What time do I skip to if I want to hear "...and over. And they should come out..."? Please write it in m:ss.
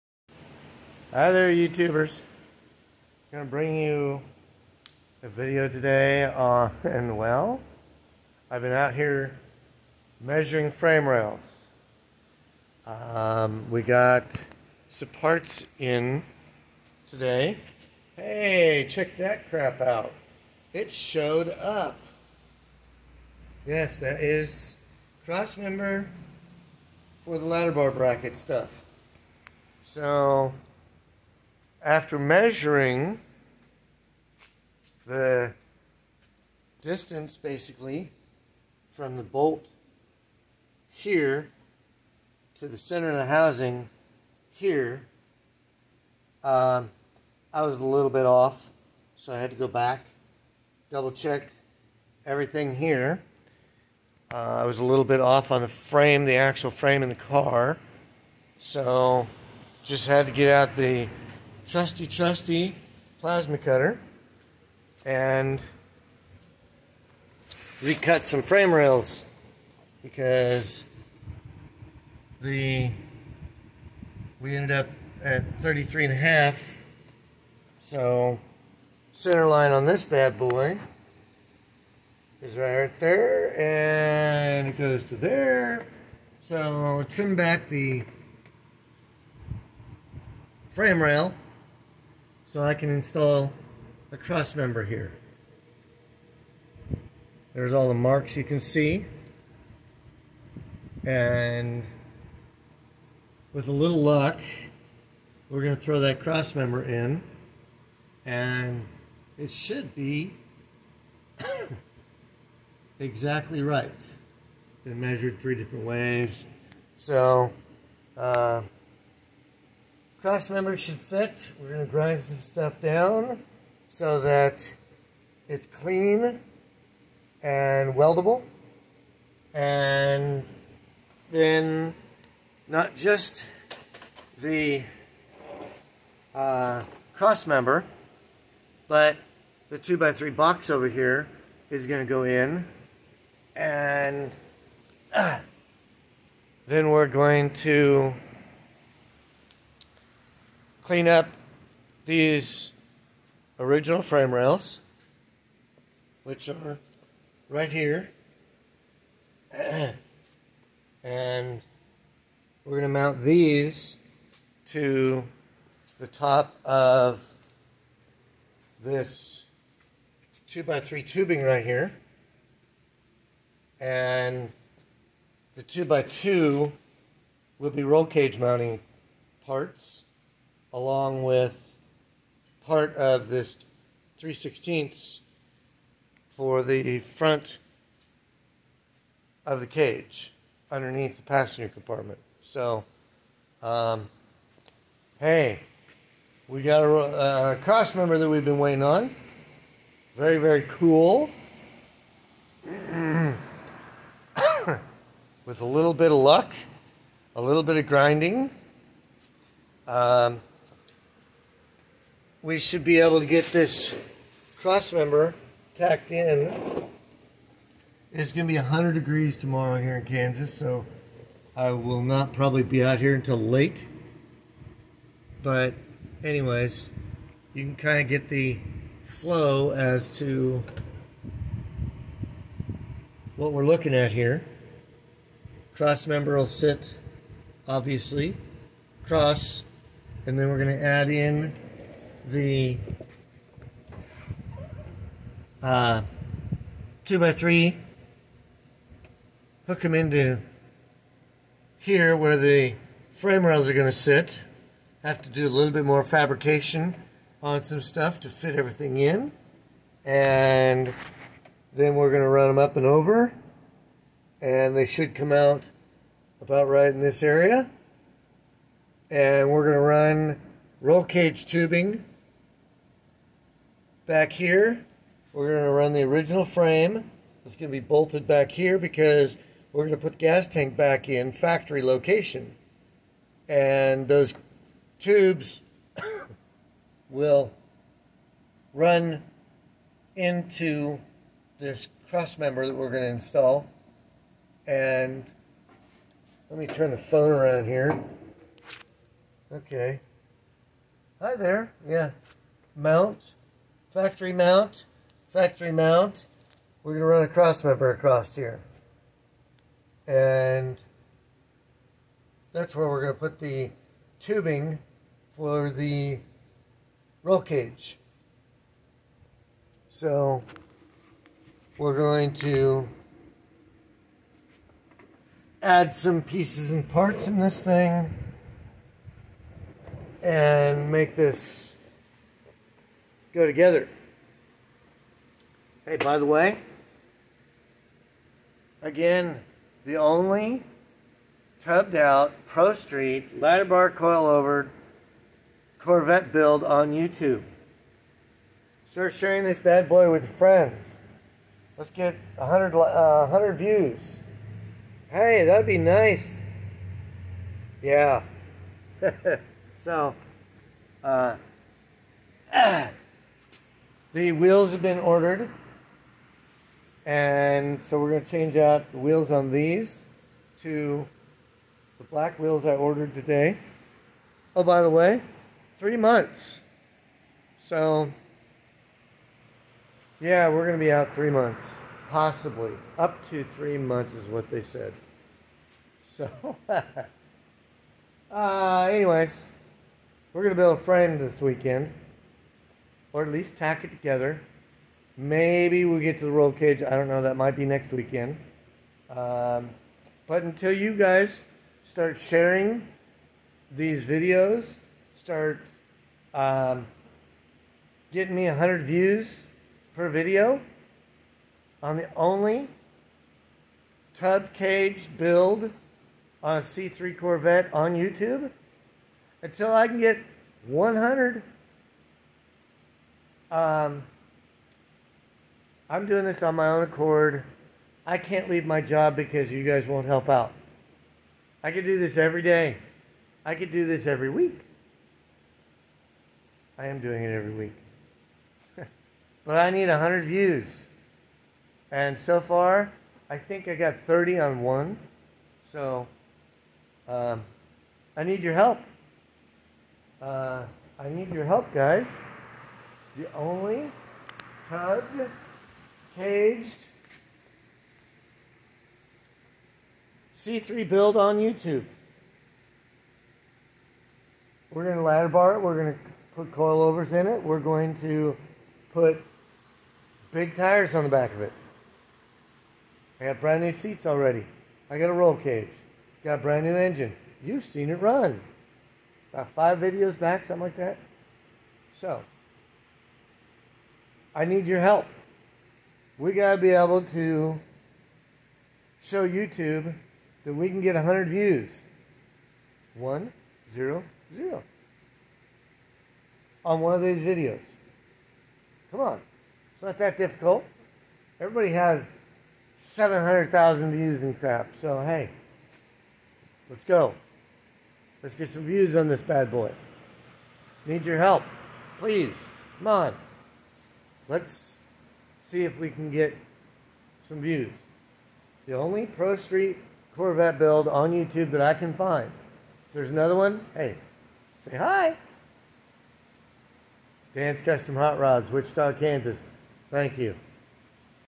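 4:22.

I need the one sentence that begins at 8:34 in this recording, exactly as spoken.
Let's see if we can get some views.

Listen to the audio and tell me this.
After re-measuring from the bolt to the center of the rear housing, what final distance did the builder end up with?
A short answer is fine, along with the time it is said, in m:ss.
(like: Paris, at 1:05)
33 and a half, at 1:15.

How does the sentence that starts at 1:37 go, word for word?
There's all the marks you can see.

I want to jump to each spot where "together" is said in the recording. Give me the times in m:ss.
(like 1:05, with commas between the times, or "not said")
5:33, 6:33.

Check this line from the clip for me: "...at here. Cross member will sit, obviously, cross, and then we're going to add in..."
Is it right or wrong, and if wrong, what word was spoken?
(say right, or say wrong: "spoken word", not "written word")
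right.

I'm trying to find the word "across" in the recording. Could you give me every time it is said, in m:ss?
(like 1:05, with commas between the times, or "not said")
5:07.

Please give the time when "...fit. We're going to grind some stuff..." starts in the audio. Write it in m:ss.
2:00.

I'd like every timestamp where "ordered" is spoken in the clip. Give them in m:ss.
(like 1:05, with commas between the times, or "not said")
6:04, 6:12.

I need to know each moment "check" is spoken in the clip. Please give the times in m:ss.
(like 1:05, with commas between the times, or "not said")
0:18, 0:51.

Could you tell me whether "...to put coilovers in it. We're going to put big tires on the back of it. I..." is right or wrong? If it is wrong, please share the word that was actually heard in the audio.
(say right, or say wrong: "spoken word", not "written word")
right.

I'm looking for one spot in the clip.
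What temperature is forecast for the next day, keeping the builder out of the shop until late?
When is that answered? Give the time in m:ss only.
3:38.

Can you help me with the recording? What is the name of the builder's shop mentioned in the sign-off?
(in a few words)
Dan's Custom Hot Rods.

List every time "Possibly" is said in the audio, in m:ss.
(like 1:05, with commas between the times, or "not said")
6:22.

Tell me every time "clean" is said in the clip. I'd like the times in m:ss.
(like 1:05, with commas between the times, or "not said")
2:05, 2:30.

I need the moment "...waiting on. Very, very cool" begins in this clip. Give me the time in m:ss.
3:18.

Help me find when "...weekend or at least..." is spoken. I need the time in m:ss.
6:31.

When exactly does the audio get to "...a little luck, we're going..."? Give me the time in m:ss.
1:43.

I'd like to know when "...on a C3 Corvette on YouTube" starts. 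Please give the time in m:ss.
6:56.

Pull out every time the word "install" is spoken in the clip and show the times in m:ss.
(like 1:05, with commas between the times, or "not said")
1:32, 4:53.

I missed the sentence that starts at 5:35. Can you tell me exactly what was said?
Hey, by the way, again, the only tubbed out Pro Street ladder bar coilover Corvette build on YouTube.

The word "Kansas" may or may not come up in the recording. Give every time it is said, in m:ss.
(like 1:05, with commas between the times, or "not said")
3:40, 8:48.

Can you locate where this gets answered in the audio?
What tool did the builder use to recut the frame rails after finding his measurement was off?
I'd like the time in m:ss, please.
1:03.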